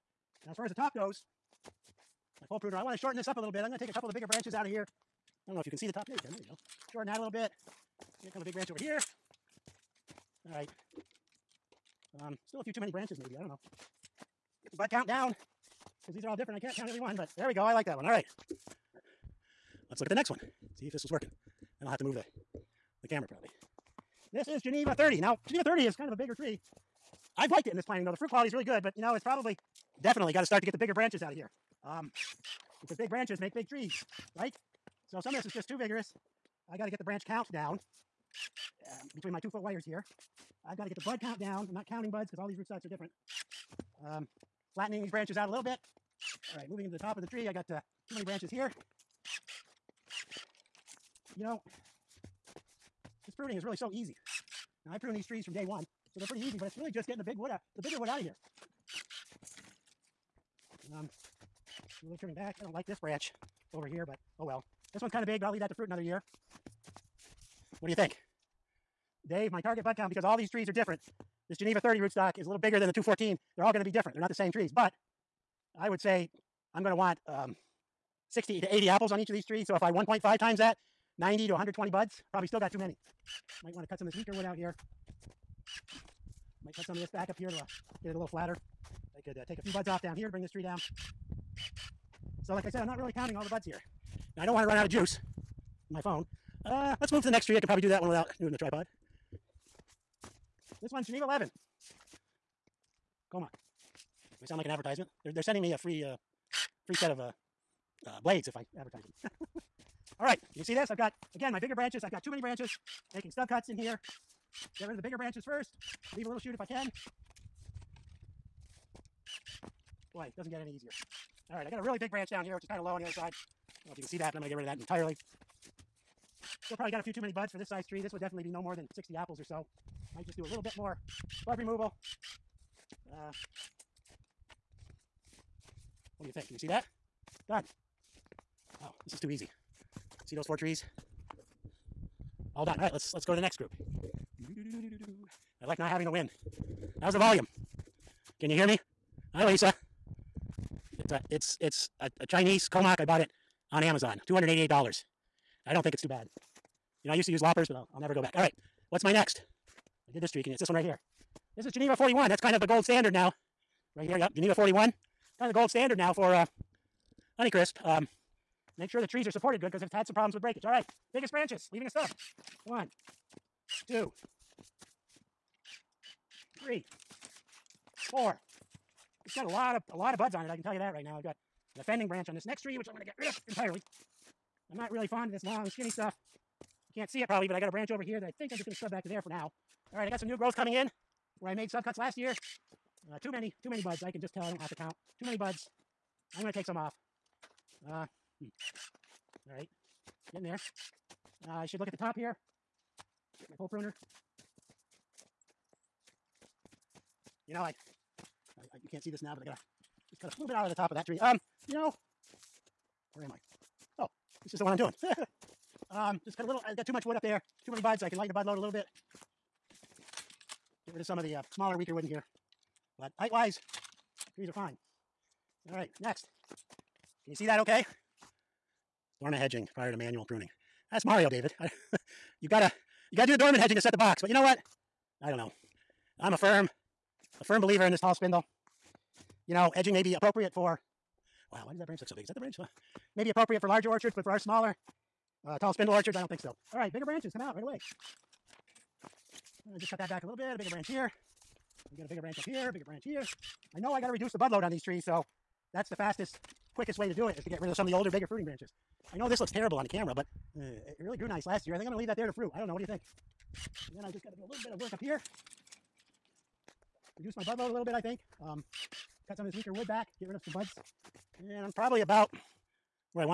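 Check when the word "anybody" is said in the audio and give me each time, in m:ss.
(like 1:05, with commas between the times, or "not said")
not said.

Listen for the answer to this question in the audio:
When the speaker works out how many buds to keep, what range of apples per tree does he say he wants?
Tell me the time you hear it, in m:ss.
1:18.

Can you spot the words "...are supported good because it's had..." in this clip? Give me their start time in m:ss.
2:49.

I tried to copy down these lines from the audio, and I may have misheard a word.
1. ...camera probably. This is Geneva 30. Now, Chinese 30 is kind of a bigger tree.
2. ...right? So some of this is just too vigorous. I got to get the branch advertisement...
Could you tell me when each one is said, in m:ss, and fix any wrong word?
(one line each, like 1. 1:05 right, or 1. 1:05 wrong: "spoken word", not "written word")
1. 0:23 wrong: "Geneva", not "Chinese"
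2. 0:34 wrong: "count", not "advertisement".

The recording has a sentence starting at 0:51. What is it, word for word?
You know, this pruning is really so easy.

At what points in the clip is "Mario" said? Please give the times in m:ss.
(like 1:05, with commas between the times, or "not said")
3:51.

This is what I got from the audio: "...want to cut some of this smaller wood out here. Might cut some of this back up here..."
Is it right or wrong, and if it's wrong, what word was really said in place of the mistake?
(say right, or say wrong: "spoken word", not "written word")
wrong: "weaker", not "smaller".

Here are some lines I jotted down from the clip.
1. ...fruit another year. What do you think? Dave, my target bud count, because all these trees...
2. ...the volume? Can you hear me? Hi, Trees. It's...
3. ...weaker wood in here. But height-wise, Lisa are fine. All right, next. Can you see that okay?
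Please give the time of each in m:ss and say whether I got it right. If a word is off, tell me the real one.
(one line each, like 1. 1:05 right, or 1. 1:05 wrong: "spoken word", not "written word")
1. 1:05 right
2. 2:27 wrong: "Lisa", not "Trees"
3. 3:41 wrong: "Trees", not "Lisa".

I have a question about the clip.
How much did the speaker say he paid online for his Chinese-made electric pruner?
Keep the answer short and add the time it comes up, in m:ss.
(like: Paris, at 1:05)
$288, at 2:34.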